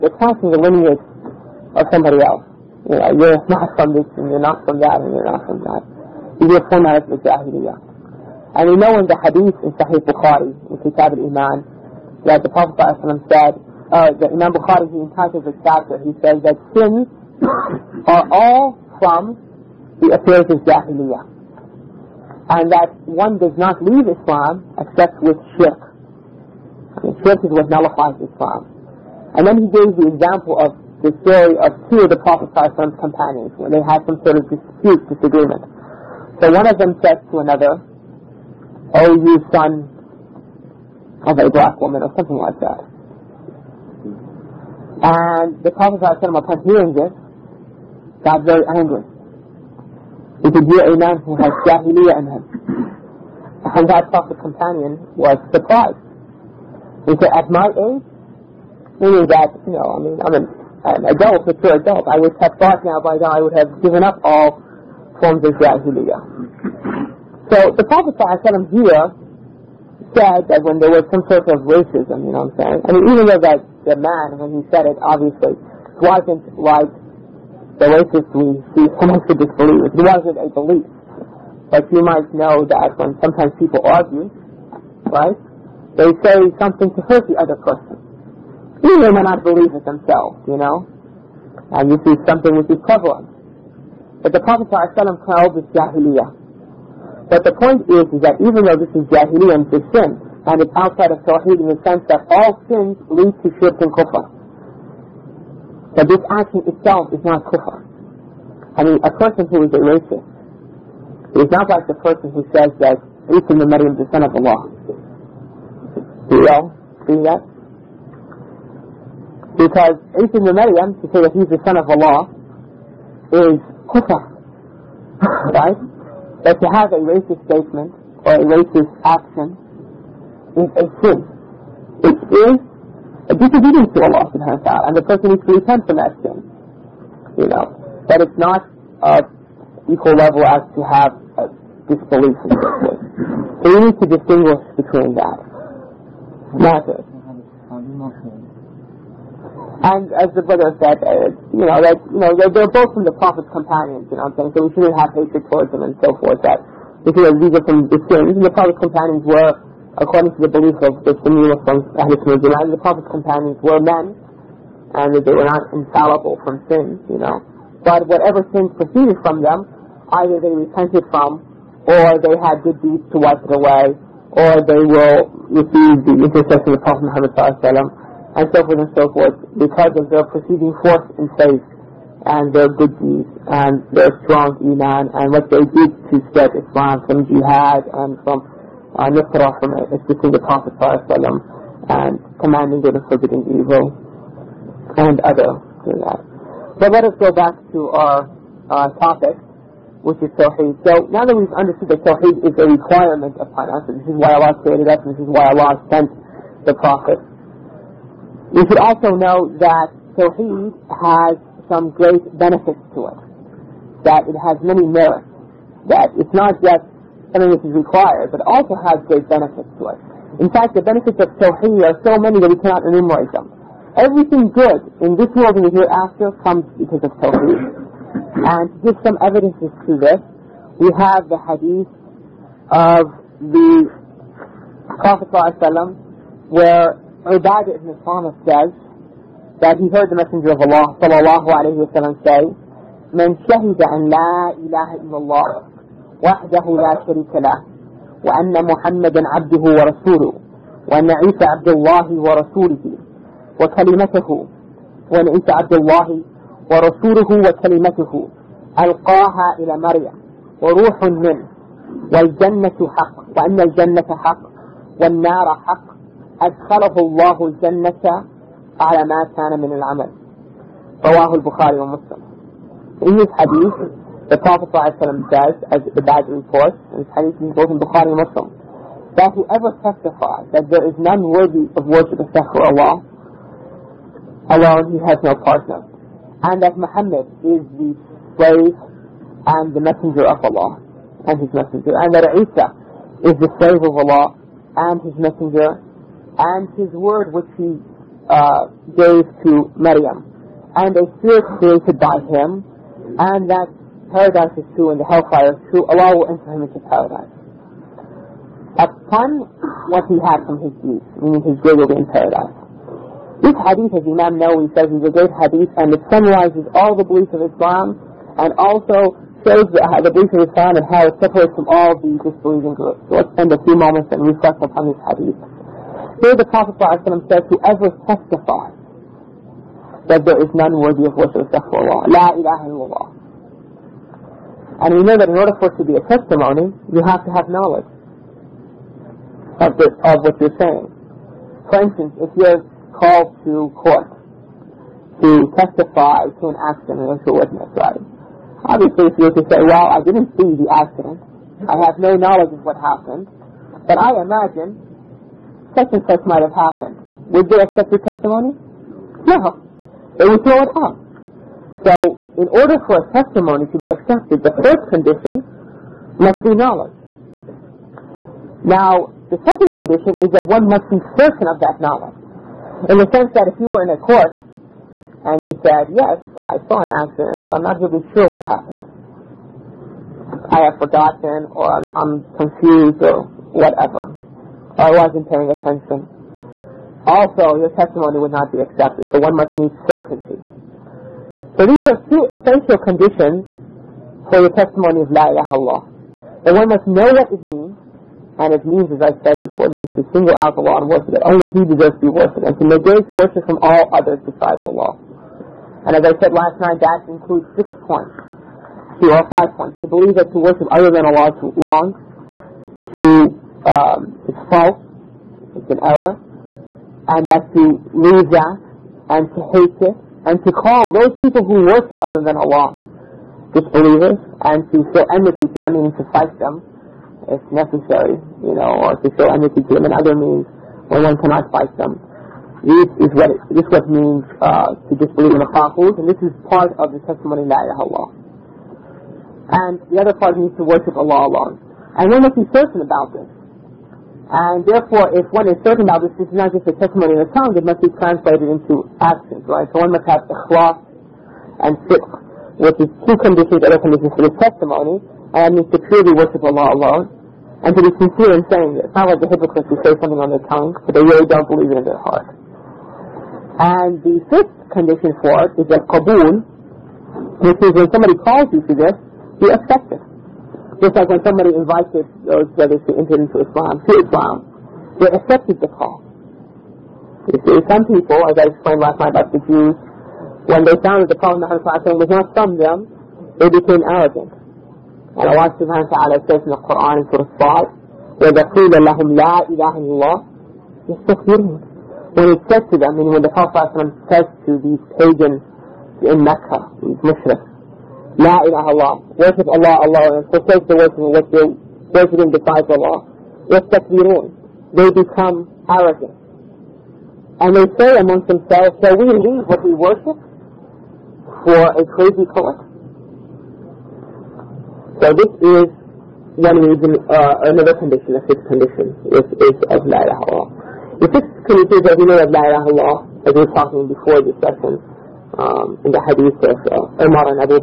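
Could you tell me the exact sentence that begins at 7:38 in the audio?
It's not like the hypocrites who say something on their tongue, but they really don't believe it in their heart.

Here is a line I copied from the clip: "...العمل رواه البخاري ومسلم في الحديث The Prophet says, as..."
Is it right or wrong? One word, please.
right.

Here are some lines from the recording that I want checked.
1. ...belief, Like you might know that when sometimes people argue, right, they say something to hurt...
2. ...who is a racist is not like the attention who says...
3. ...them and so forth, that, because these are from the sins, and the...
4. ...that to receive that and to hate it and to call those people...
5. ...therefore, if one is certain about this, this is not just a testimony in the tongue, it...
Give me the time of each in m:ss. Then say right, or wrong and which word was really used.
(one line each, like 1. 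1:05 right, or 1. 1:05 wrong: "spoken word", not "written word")
1. 1:20 right
2. 1:49 wrong: "person", not "attention"
3. 2:35 right
4. 6:57 wrong: "leave", not "receive"
5. 7:24 right.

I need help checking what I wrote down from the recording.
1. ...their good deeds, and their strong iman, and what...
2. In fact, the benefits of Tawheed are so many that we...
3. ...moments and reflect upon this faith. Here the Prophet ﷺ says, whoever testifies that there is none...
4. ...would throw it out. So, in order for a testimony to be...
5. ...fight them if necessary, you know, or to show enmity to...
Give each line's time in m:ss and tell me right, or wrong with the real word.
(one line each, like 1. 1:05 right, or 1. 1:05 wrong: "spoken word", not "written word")
1. 3:02 right
2. 3:40 right
3. 5:23 wrong: "hadith", not "faith"
4. 6:00 right
5. 7:06 right.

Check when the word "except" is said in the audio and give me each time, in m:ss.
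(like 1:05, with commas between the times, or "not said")
0:24, 4:42, 5:31.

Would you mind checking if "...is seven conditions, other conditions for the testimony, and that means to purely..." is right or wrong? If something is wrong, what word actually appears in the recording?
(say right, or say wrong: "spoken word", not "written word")
wrong: "two", not "seven".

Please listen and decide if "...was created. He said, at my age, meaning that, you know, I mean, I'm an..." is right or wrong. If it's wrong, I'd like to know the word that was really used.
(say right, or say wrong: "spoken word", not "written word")
wrong: "surprised", not "created".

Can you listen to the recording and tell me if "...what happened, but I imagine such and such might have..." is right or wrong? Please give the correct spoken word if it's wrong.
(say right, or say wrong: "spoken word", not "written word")
right.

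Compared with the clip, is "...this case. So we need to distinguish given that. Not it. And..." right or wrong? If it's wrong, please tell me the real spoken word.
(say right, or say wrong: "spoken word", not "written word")
wrong: "between", not "given".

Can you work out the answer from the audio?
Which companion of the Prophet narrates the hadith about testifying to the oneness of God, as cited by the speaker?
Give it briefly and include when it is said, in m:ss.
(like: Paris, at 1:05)
Ubadah ibn Samit, at 3:57.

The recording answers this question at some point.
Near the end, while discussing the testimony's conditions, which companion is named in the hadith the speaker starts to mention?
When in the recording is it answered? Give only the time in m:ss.
8:47.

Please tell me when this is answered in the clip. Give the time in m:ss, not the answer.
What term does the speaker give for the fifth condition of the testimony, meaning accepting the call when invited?
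7:45.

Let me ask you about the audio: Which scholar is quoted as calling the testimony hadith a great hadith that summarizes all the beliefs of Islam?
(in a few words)
Imam Nawawi.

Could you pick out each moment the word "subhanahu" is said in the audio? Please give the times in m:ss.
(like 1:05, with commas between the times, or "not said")
2:14, 8:05.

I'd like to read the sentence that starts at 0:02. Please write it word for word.
You know, you're not from this, and you're not from that, and you're not from that.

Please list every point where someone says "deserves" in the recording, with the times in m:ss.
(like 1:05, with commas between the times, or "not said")
6:41.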